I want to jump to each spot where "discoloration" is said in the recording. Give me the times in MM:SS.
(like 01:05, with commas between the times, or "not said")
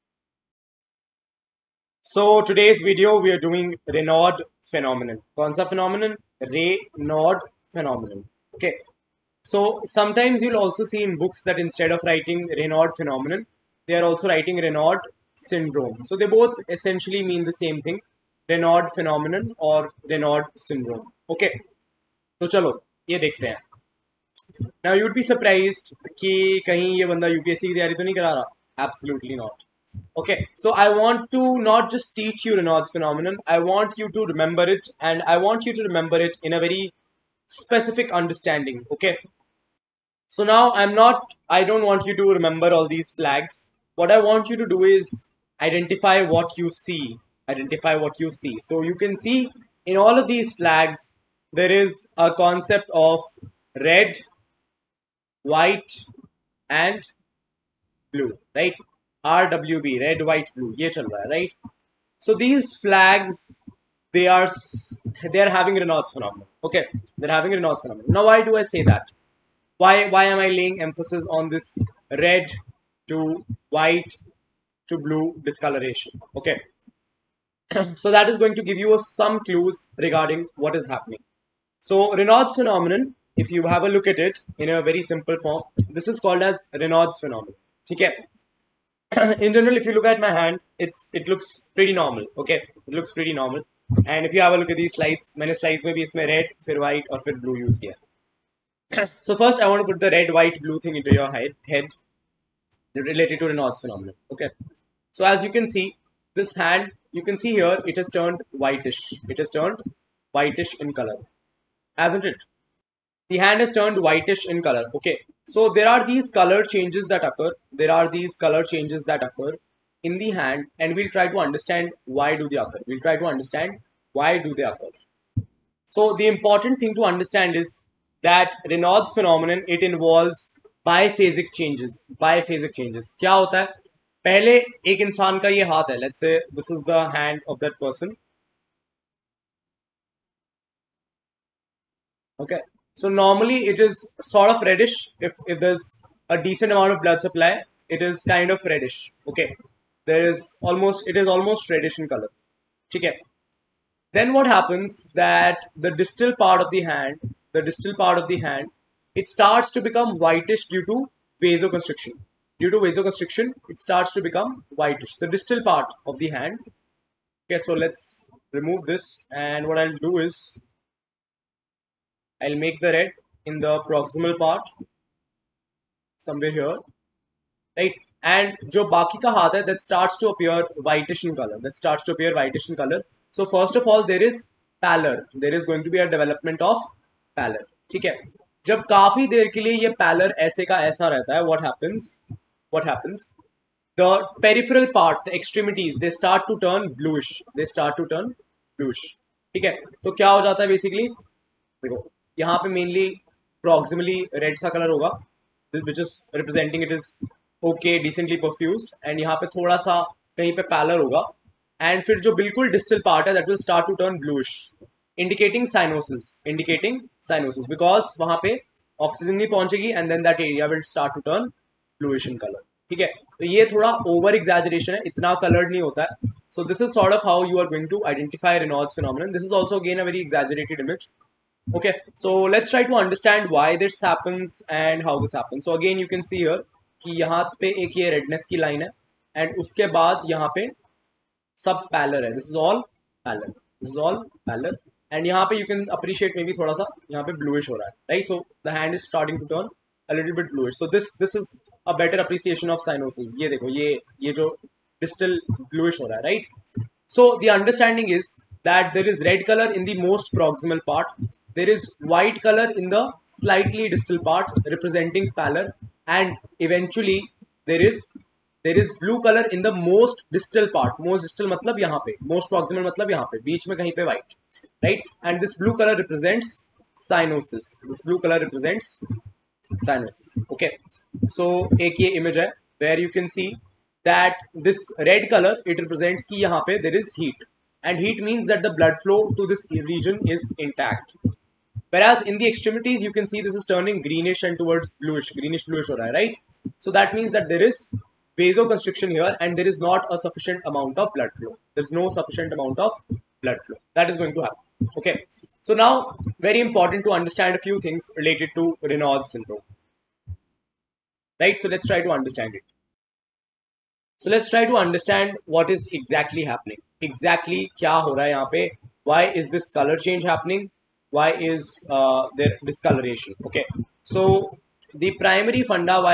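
01:15, 05:22.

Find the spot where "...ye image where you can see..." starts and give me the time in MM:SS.
04:42.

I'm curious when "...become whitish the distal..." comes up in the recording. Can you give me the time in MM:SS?
02:44.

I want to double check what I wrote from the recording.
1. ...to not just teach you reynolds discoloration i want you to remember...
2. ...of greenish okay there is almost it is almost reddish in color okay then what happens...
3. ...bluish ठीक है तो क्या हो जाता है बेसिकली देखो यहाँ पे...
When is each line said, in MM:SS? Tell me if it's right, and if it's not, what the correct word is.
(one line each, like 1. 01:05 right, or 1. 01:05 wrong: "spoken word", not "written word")
1. 00:31 wrong: "phenomenon", not "discoloration"
2. 02:28 wrong: "reddish", not "greenish"
3. 03:18 right.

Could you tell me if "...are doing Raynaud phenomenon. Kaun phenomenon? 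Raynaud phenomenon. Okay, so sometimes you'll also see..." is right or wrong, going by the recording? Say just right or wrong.
right.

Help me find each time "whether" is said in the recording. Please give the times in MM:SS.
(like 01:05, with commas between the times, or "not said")
not said.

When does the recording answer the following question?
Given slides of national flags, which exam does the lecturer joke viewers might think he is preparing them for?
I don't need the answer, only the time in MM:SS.
00:27.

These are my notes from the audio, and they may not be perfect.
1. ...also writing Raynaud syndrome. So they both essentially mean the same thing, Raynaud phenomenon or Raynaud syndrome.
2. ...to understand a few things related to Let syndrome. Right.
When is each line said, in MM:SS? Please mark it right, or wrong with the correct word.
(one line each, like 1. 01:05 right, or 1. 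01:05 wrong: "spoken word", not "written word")
1. 00:14 right
2. 05:07 wrong: "Reynolds", not "Let".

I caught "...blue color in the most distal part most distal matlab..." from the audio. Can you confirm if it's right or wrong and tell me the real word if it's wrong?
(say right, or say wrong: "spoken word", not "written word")
right.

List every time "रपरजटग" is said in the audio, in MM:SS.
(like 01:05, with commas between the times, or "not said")
03:26, 04:24.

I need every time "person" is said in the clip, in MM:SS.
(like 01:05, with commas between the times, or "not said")
02:17.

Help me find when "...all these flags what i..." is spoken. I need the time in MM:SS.
00:42.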